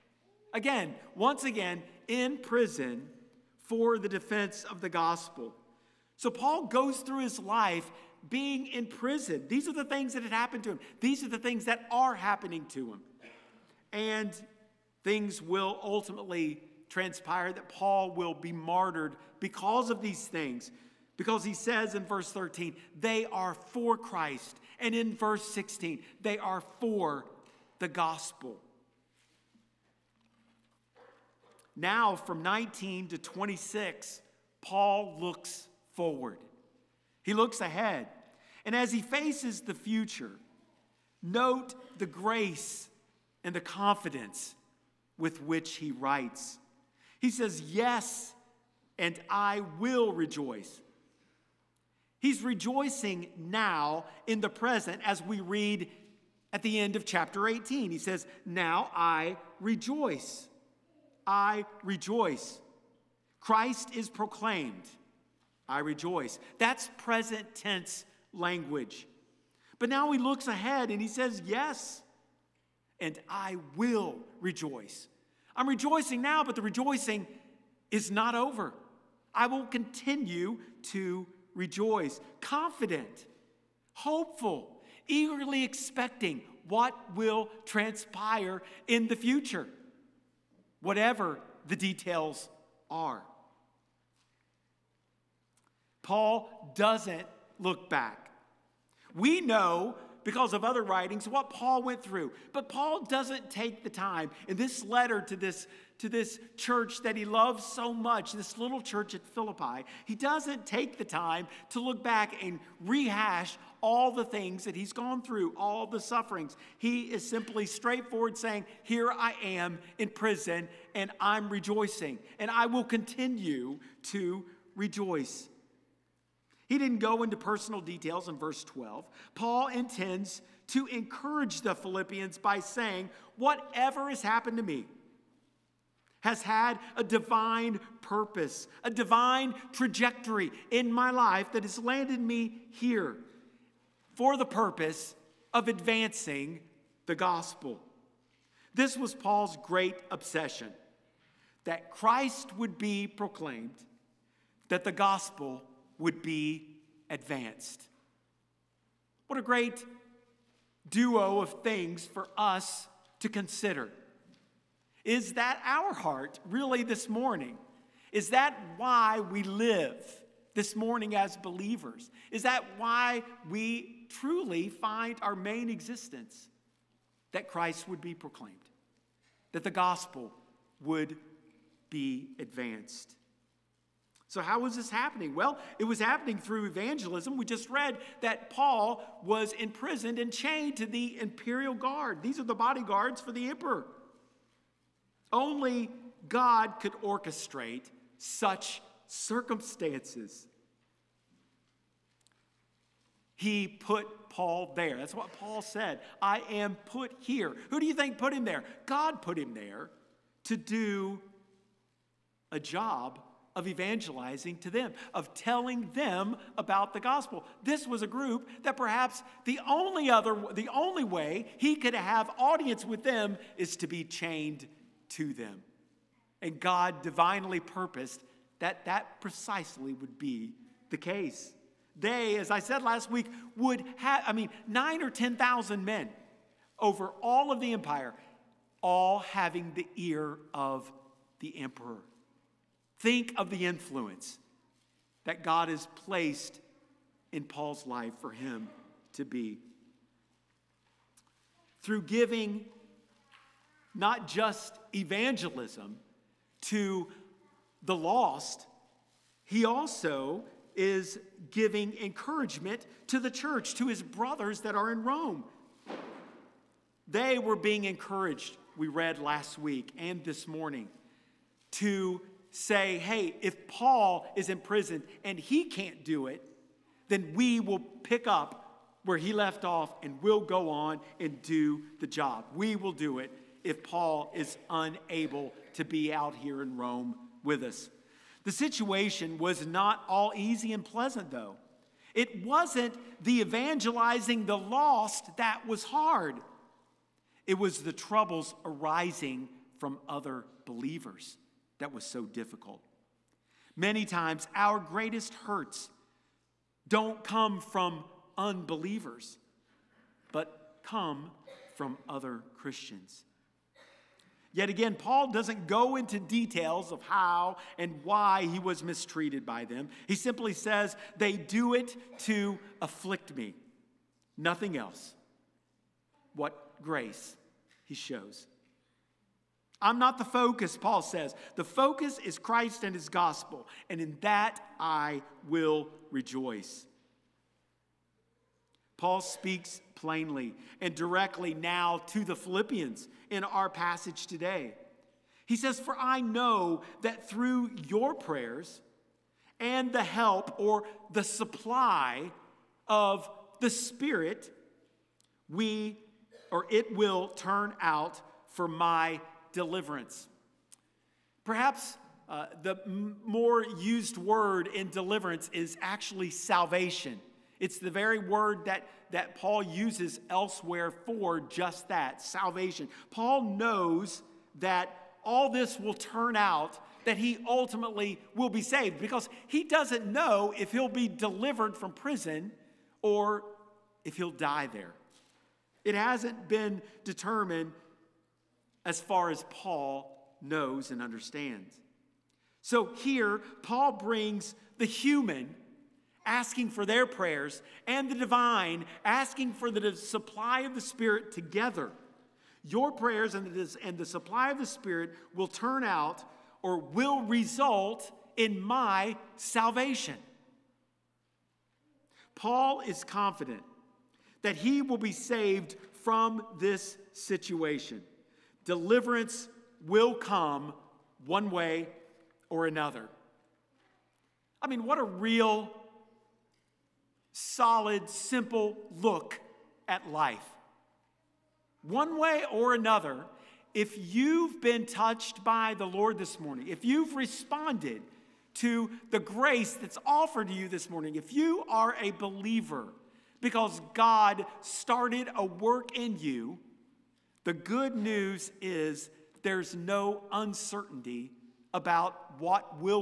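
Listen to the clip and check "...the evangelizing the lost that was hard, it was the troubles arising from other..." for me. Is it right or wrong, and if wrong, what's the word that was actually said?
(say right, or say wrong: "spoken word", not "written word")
right.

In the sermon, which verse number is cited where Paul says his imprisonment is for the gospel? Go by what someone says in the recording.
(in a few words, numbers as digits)
16.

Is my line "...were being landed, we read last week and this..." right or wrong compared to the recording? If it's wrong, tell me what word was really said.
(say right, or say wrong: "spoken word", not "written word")
wrong: "encouraged", not "landed".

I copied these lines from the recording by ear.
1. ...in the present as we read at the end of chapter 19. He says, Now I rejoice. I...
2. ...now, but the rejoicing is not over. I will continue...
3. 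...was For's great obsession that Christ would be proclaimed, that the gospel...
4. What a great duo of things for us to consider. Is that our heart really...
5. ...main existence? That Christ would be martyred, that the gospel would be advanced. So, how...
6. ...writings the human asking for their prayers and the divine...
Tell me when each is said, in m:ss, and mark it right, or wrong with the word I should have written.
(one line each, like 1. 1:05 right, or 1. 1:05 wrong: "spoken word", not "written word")
1. 0:54 wrong: "18", not "19"
2. 1:16 right
3. 2:28 wrong: "Paul", not "For"
4. 2:39 right
5. 2:55 wrong: "proclaimed", not "martyred"
6. 6:33 wrong: "brings", not "writings".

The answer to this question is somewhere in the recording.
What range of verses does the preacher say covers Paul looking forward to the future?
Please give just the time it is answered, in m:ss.
0:32.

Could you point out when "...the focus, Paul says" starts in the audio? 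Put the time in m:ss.
5:30.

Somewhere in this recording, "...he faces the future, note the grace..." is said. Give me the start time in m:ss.
0:38.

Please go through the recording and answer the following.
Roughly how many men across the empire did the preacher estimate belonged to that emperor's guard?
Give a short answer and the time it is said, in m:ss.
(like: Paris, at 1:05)
9,000 or 10,000, at 3:54.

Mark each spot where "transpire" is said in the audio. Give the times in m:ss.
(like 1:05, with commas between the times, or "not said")
0:16, 1:27.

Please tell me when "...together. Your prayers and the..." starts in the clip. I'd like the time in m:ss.
6:41.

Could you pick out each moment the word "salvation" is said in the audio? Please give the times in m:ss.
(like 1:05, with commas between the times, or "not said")
6:06, 6:12, 6:49.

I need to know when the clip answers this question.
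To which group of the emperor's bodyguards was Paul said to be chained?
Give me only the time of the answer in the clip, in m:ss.
3:11.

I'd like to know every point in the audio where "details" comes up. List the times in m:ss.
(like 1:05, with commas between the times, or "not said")
1:31, 2:07, 5:16.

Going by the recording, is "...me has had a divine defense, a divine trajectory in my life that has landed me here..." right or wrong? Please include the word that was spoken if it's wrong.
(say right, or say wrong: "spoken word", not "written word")
wrong: "purpose", not "defense".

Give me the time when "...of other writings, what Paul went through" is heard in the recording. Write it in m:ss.
1:40.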